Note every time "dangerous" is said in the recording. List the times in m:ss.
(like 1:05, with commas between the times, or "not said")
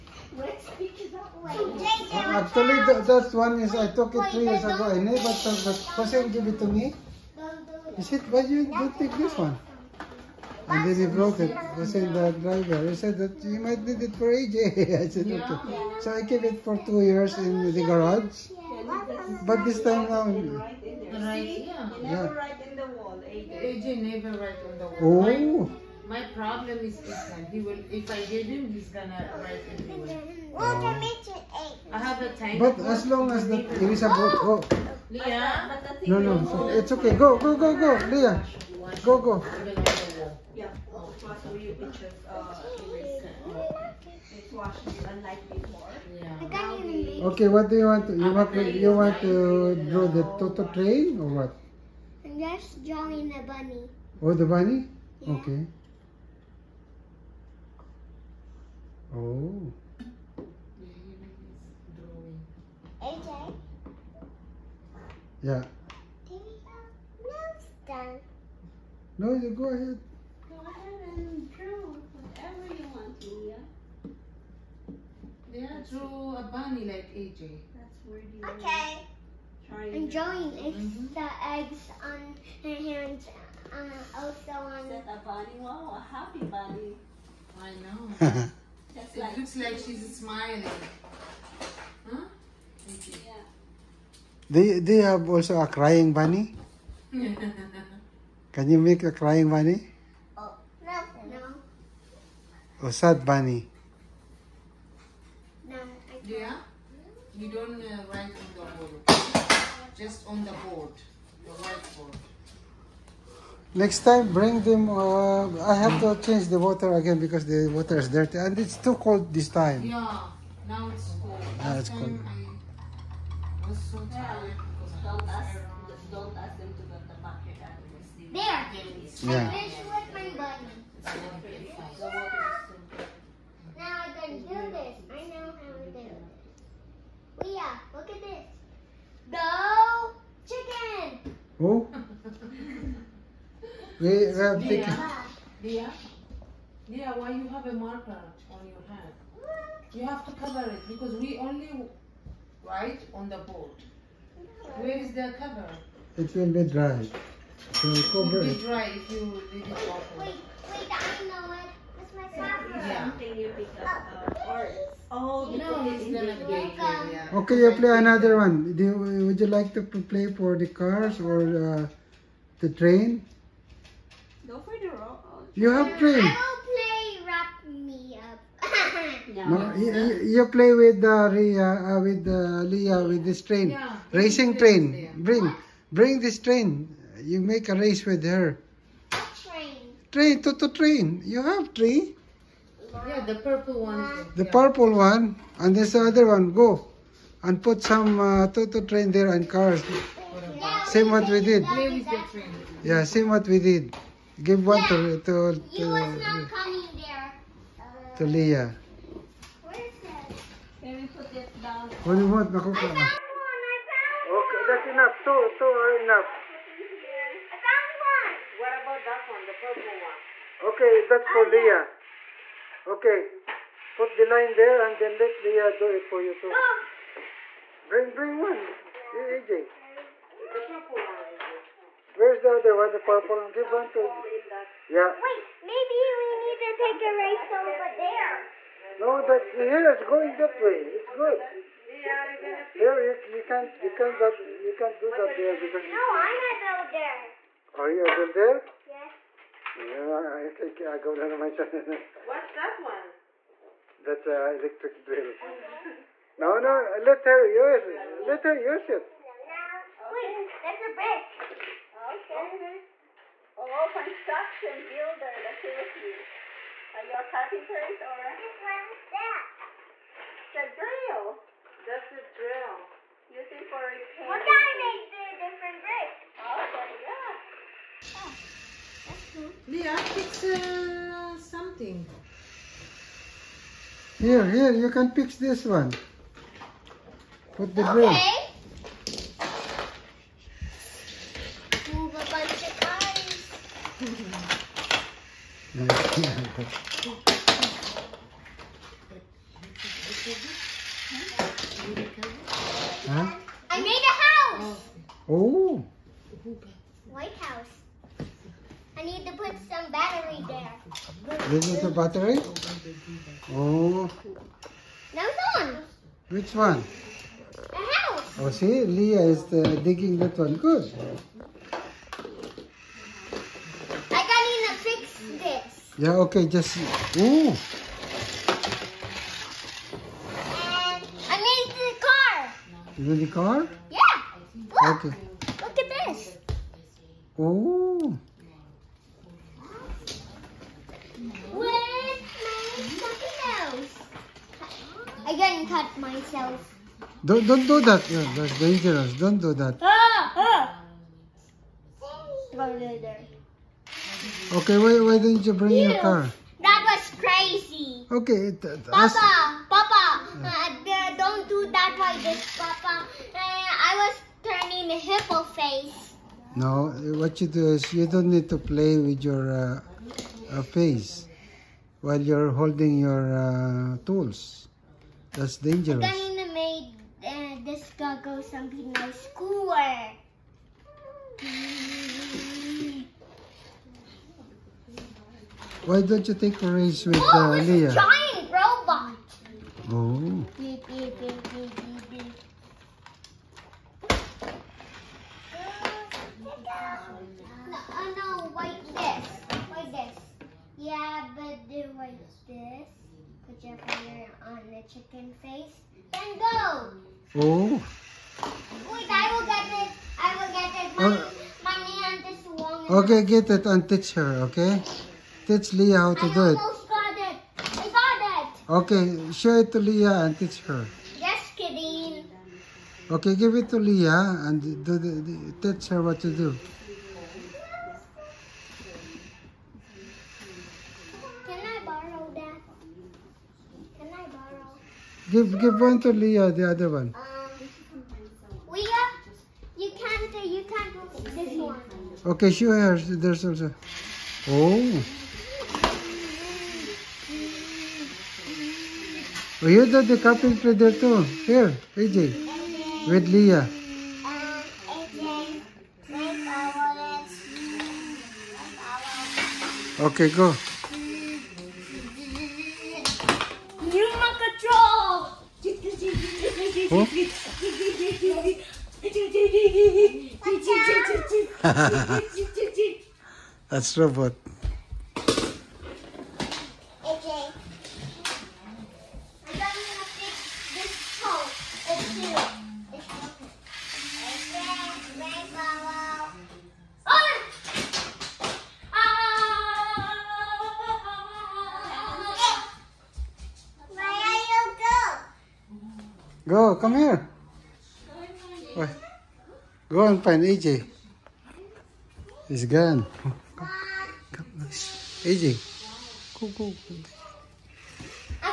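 5:48, 6:15.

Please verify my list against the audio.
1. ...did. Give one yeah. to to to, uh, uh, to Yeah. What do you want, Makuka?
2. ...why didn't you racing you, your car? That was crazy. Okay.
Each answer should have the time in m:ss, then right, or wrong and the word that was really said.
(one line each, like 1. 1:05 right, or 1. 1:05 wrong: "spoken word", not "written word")
1. 3:23 wrong: "Liyah", not "Yeah"
2. 5:55 wrong: "bring", not "racing".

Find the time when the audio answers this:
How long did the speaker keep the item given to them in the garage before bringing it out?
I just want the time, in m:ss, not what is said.
0:16.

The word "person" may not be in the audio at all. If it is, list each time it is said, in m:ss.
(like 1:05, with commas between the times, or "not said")
0:05.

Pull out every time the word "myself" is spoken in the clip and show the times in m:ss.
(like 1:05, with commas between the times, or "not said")
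5:45.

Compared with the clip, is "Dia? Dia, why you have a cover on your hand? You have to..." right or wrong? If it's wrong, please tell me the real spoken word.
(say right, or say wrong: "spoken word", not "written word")
wrong: "marker", not "cover".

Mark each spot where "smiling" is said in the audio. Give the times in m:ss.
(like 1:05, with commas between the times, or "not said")
1:30.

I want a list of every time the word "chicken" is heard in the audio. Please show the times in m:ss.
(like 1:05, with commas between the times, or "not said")
2:20, 6:44.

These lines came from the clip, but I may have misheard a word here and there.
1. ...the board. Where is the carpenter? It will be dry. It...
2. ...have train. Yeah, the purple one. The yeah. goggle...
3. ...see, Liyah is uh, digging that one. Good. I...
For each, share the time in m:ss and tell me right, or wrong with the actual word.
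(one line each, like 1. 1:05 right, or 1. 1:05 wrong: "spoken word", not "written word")
1. 2:33 wrong: "cover", not "carpenter"
2. 3:11 wrong: "purple", not "goggle"
3. 5:18 right.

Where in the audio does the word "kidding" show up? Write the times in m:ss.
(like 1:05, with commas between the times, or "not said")
7:01.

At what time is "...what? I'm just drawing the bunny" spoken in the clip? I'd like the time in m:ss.
0:51.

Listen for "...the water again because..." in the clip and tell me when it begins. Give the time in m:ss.
1:56.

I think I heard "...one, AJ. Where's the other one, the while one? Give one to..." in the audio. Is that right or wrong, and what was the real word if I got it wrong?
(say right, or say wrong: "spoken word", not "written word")
wrong: "purple", not "while".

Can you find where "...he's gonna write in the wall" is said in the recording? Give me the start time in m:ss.
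0:28.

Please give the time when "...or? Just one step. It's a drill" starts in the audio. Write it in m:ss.
4:27.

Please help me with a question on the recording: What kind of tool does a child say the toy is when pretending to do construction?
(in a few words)
Electric drill.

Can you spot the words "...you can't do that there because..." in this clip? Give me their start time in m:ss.
4:04.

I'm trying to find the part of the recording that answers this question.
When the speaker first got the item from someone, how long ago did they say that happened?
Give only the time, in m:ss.
0:04.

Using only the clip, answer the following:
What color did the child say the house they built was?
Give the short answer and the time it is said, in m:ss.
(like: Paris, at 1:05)
White, at 5:07.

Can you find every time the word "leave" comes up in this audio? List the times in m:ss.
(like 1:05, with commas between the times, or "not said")
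2:39.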